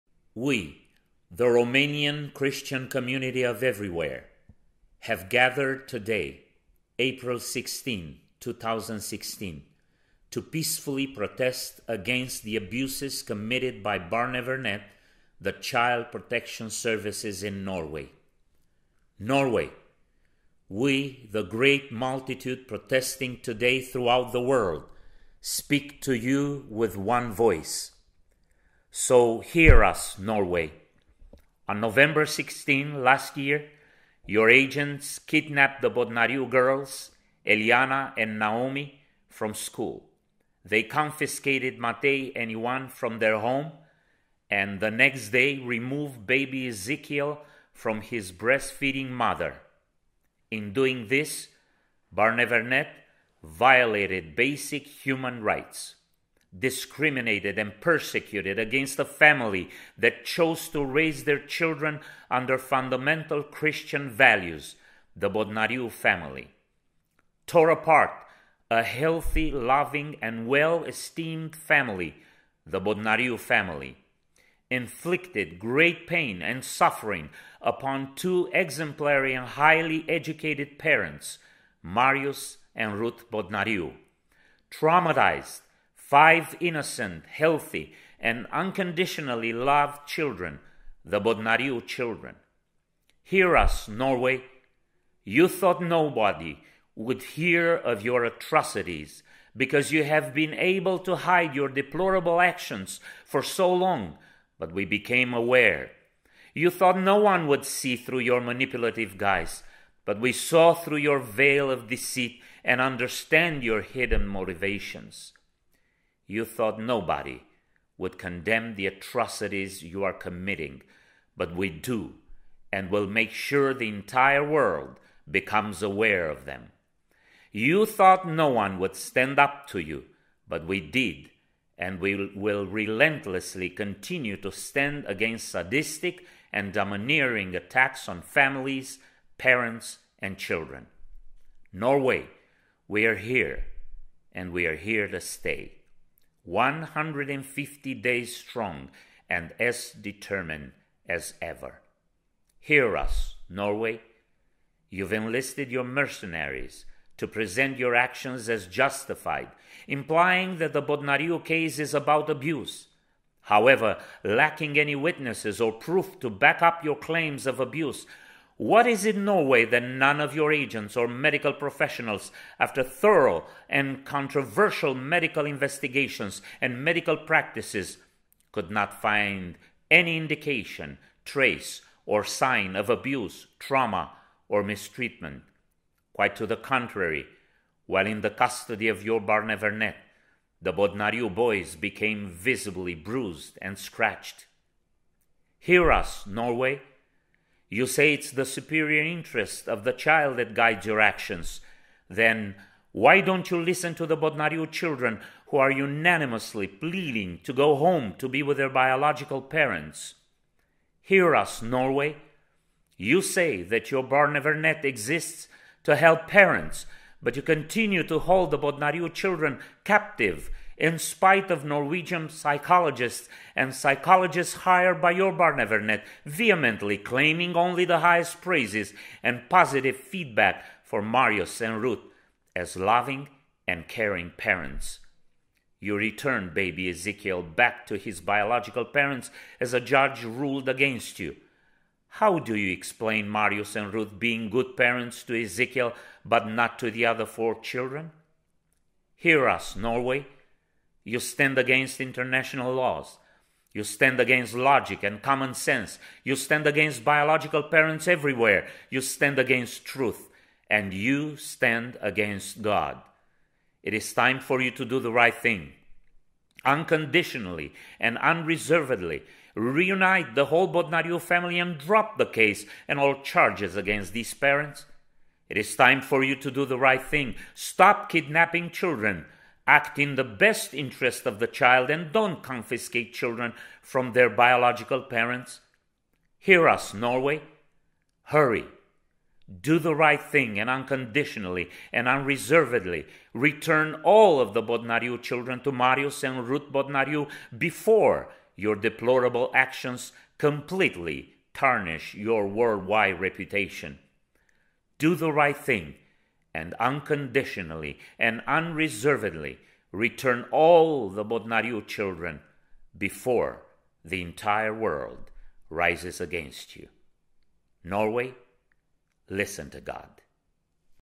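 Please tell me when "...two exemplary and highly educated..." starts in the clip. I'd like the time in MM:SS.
01:18.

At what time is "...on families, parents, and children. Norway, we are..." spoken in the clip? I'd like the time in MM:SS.
02:18.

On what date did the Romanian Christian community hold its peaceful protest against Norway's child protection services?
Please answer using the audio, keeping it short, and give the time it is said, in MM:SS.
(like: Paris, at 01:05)
April 16, 2016, at 00:06.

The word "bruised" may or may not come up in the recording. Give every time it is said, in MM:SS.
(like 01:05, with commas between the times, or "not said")
03:12.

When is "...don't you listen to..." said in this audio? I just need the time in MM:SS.
03:23.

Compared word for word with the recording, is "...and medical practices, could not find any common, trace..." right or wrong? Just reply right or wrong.
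wrong.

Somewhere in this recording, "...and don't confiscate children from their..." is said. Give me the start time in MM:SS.
04:41.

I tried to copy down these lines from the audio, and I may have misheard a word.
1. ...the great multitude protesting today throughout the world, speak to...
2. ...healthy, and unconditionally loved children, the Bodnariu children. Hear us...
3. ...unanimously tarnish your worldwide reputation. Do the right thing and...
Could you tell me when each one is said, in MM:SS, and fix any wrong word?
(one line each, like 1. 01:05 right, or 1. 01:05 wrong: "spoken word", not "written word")
1. 00:21 right
2. 01:27 right
3. 05:00 wrong: "completely", not "unanimously".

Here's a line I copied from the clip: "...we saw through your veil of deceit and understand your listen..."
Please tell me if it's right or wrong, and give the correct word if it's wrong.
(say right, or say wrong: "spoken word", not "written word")
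wrong: "hidden", not "listen".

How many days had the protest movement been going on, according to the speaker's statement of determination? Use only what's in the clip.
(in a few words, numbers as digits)
150.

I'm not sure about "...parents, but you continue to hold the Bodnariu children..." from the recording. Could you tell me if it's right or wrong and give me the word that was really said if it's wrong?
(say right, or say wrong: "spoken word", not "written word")
right.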